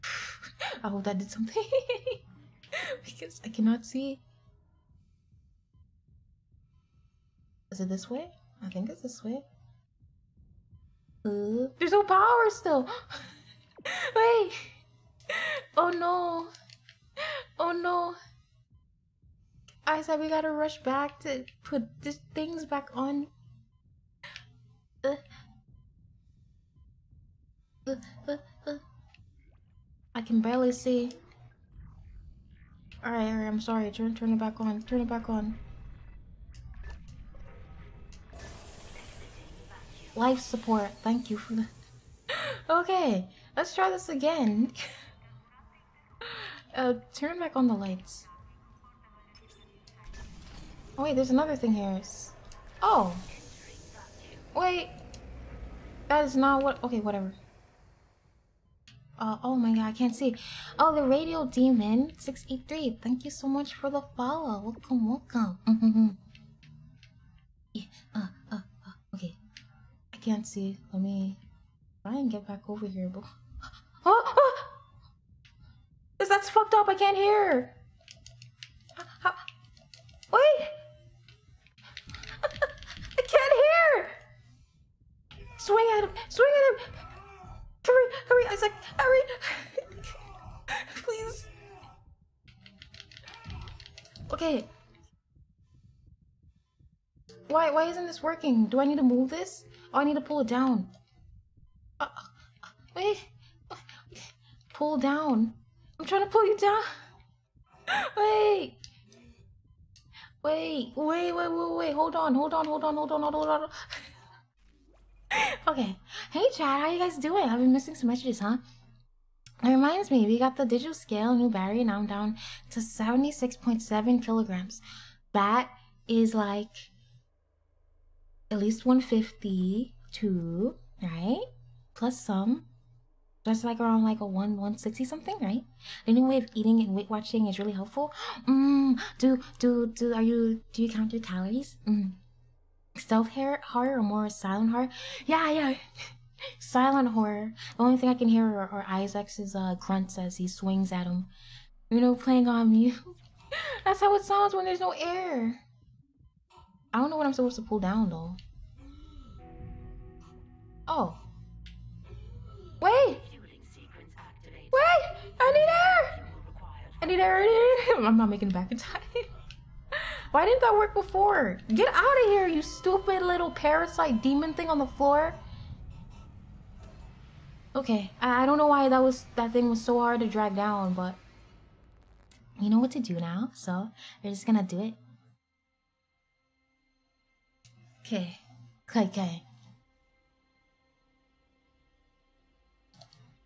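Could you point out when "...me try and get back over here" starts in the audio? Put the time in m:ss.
1:11.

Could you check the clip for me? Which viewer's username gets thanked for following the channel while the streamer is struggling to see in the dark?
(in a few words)
The Radio Demon 683.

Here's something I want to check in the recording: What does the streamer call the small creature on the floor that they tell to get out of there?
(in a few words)
parasite demon.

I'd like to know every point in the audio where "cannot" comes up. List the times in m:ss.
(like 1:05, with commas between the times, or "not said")
0:03.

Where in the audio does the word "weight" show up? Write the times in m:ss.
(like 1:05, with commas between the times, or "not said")
2:16.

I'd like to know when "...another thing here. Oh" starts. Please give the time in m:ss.
0:51.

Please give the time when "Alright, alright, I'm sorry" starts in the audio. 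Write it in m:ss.
0:33.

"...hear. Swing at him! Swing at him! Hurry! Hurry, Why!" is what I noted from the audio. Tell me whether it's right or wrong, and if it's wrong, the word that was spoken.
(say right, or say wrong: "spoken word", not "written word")
wrong: "Isaac", not "Why".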